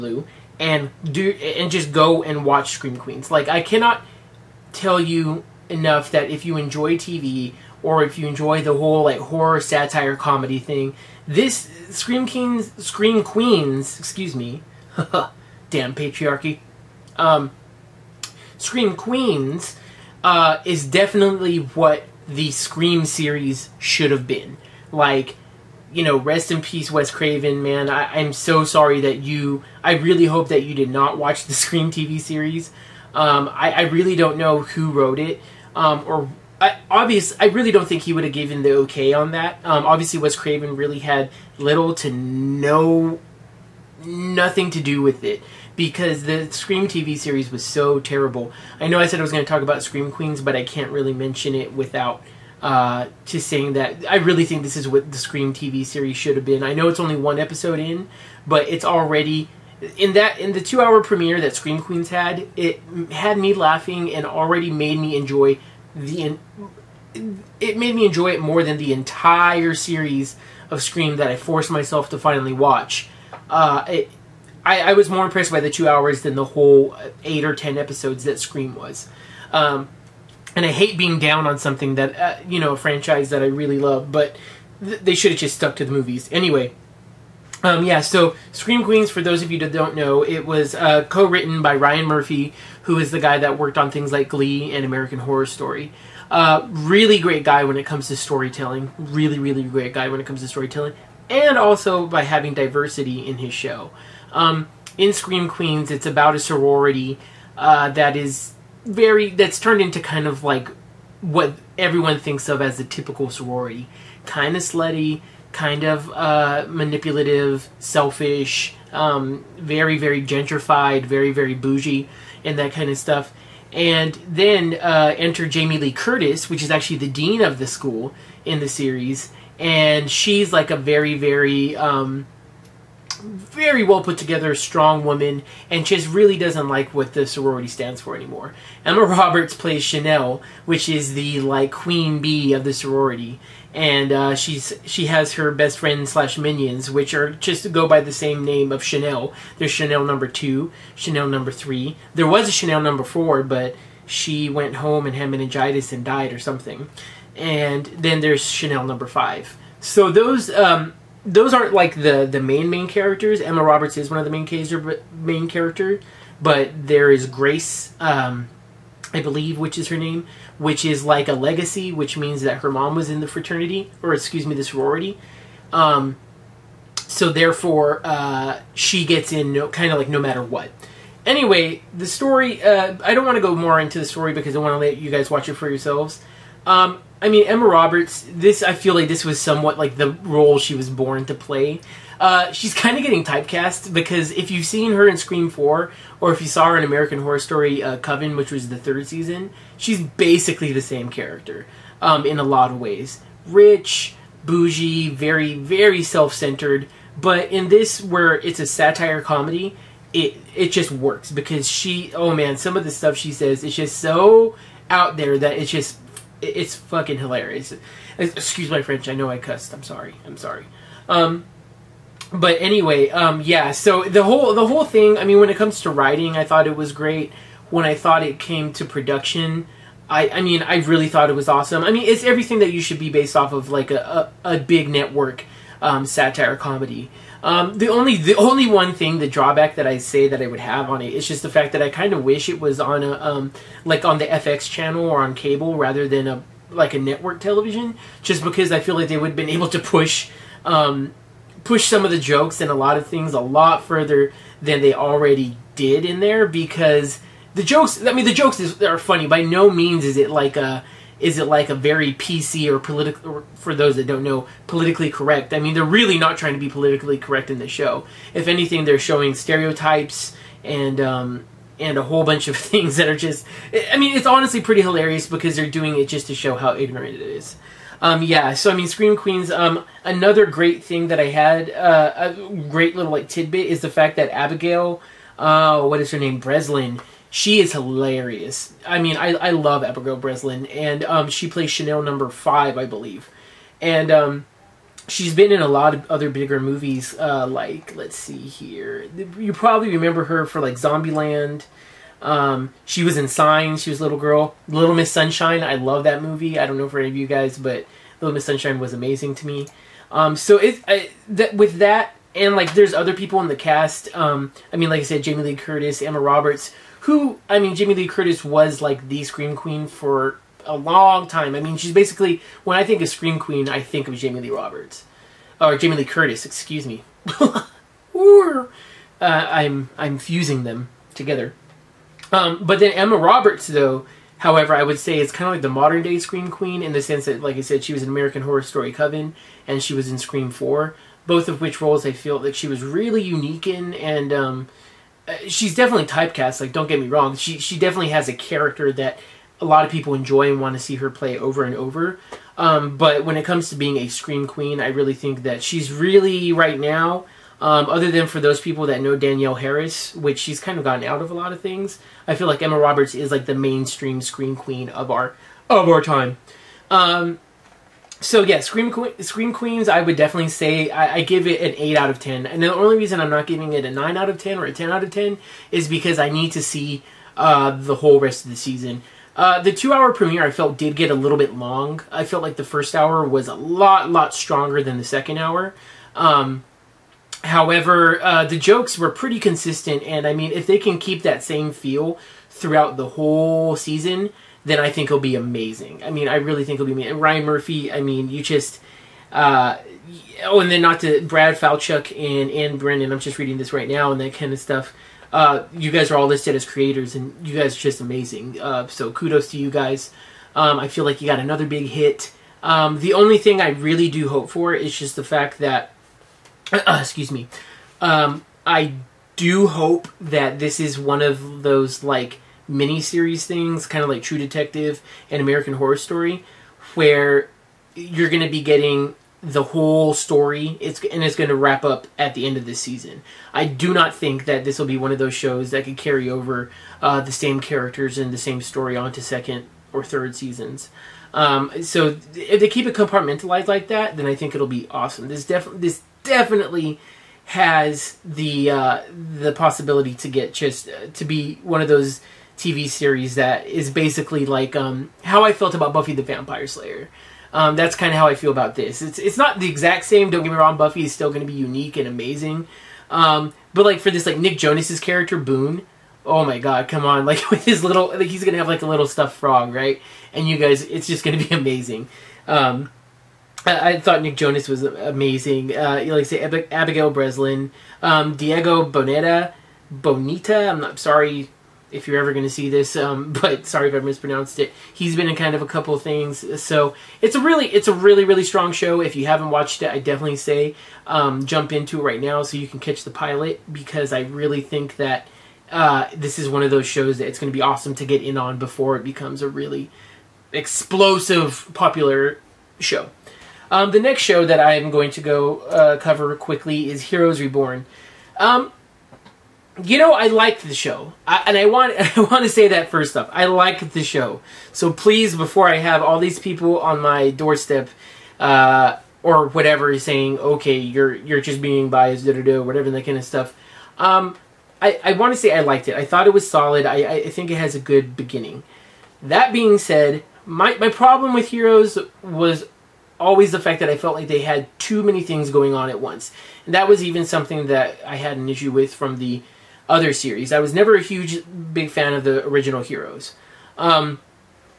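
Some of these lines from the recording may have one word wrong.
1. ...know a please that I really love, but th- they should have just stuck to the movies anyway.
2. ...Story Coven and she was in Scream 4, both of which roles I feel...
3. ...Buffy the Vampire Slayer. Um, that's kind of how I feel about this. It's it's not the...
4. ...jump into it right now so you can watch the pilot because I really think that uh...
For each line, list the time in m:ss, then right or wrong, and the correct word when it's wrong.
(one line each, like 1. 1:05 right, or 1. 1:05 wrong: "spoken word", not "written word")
1. 1:22 wrong: "franchise", not "please"
2. 5:38 right
3. 7:35 right
4. 8:11 wrong: "catch", not "watch".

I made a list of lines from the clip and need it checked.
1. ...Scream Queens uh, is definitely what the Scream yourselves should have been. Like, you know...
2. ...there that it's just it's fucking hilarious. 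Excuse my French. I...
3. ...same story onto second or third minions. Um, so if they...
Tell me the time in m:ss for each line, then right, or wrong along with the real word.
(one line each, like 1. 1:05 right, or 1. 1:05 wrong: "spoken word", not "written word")
1. 0:18 wrong: "series", not "yourselves"
2. 3:35 right
3. 7:18 wrong: "seasons", not "minions".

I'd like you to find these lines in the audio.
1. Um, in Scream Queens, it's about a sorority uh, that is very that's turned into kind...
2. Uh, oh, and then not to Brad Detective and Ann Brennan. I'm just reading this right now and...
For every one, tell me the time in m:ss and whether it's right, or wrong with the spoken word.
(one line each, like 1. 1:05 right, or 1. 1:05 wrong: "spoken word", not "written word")
1. 1:44 right
2. 6:39 wrong: "Falchuk", not "Detective".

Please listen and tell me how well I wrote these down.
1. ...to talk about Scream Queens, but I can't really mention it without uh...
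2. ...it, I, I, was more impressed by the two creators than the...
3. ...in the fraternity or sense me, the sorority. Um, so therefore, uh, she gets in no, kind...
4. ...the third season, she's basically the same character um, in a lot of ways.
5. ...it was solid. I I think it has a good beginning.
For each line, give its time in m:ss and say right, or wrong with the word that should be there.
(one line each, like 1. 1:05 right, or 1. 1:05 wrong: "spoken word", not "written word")
1. 0:49 right
2. 1:13 wrong: "hours", not "creators"
3. 2:53 wrong: "excuse", not "sense"
4. 3:18 right
5. 8:46 right.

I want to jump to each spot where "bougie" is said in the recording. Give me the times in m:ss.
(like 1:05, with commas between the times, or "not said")
2:01, 3:24.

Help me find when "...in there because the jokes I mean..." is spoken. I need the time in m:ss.
4:16.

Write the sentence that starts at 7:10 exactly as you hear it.
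It's and it's going to wrap up at the end of this season.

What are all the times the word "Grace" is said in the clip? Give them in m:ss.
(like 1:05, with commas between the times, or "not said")
2:47.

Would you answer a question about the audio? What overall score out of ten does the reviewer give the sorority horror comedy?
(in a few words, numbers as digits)
8.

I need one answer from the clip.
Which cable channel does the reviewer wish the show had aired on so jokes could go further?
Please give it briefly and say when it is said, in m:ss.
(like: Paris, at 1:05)
FX, at 4:04.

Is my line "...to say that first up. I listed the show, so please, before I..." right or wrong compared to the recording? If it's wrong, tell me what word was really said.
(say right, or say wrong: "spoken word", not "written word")
wrong: "liked", not "listed".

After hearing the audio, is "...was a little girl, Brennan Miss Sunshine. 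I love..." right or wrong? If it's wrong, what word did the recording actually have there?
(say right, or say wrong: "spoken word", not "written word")
wrong: "Little", not "Brennan".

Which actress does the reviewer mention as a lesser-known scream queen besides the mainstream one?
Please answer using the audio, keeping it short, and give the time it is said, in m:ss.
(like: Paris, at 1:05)
Danielle Harris, at 5:59.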